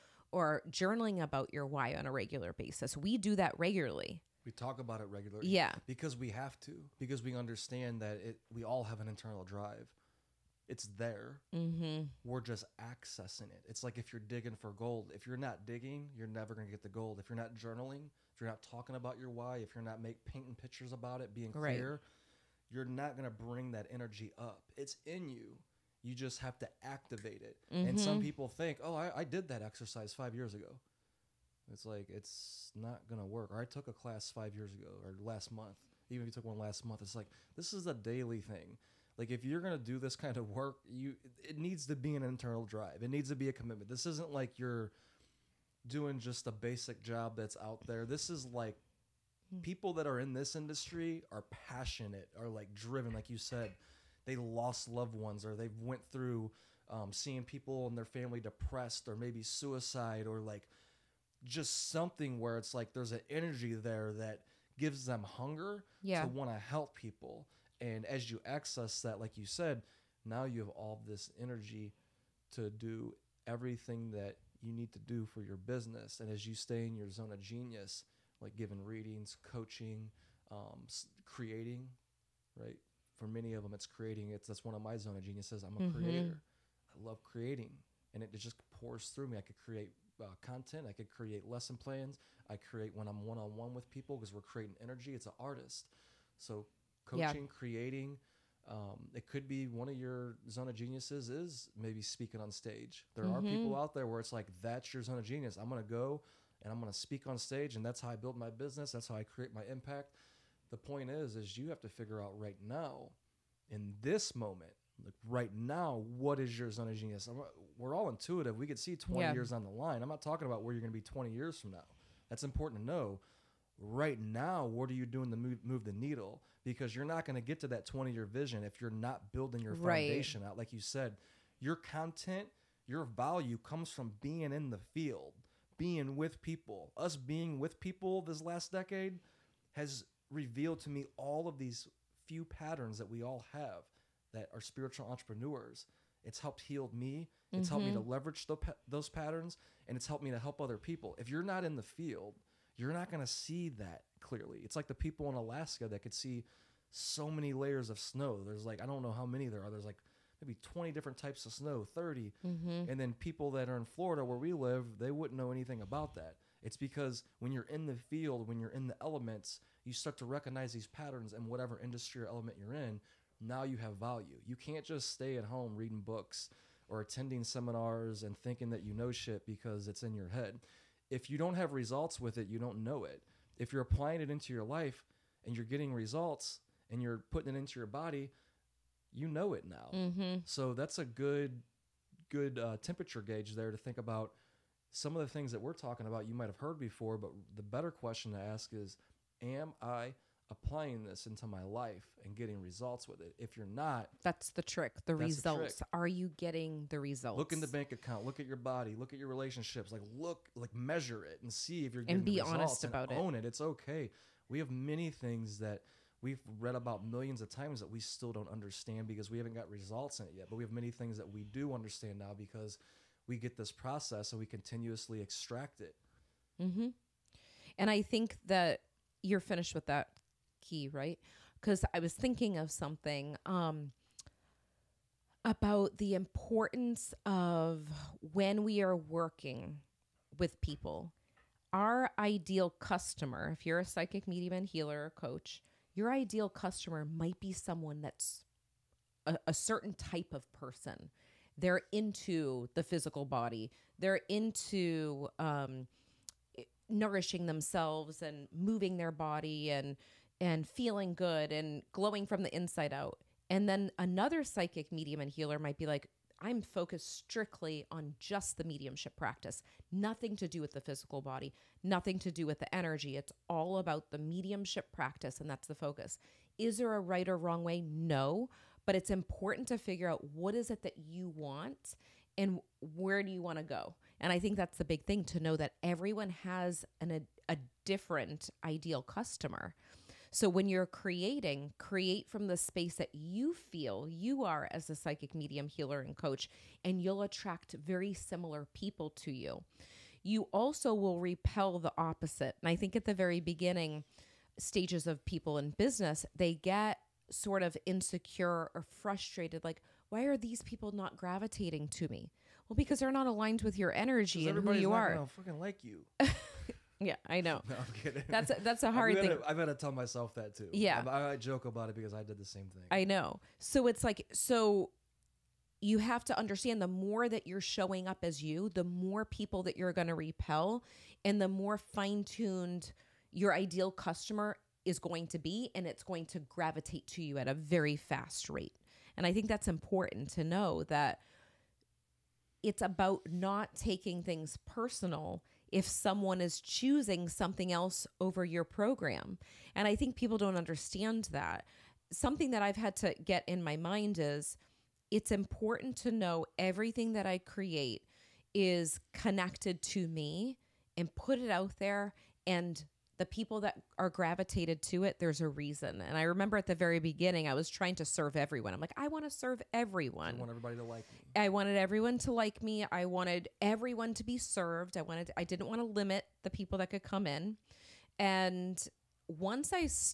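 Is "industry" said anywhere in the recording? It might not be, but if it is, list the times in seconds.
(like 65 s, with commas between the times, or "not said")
50 s, 171 s.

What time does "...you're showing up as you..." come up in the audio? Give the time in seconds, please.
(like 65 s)
327 s.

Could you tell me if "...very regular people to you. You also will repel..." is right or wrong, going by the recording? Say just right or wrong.
wrong.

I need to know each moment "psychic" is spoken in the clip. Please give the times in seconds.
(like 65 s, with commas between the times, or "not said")
243 s, 264 s, 294 s.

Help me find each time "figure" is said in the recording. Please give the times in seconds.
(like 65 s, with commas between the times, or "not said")
111 s, 279 s.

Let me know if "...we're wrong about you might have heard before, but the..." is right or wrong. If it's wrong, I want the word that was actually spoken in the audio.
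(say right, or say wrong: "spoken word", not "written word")
wrong: "talking", not "wrong".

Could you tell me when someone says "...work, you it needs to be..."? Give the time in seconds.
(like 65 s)
40 s.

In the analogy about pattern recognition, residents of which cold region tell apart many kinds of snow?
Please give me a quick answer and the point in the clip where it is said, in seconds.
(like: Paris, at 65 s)
Alaska, at 155 s.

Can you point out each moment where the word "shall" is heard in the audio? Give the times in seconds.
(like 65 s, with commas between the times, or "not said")
not said.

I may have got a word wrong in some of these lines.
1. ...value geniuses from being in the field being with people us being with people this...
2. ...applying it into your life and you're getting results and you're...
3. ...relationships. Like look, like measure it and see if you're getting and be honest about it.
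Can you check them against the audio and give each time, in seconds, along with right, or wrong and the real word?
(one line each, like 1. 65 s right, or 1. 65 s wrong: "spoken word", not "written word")
1. 133 s wrong: "comes", not "geniuses"
2. 183 s right
3. 209 s right.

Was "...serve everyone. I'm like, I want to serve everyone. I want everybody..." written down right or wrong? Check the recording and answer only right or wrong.
right.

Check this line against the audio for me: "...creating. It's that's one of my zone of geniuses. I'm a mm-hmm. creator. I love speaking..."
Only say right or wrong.
wrong.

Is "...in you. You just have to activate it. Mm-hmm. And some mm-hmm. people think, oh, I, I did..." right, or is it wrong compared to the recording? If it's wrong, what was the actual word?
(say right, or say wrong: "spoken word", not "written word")
right.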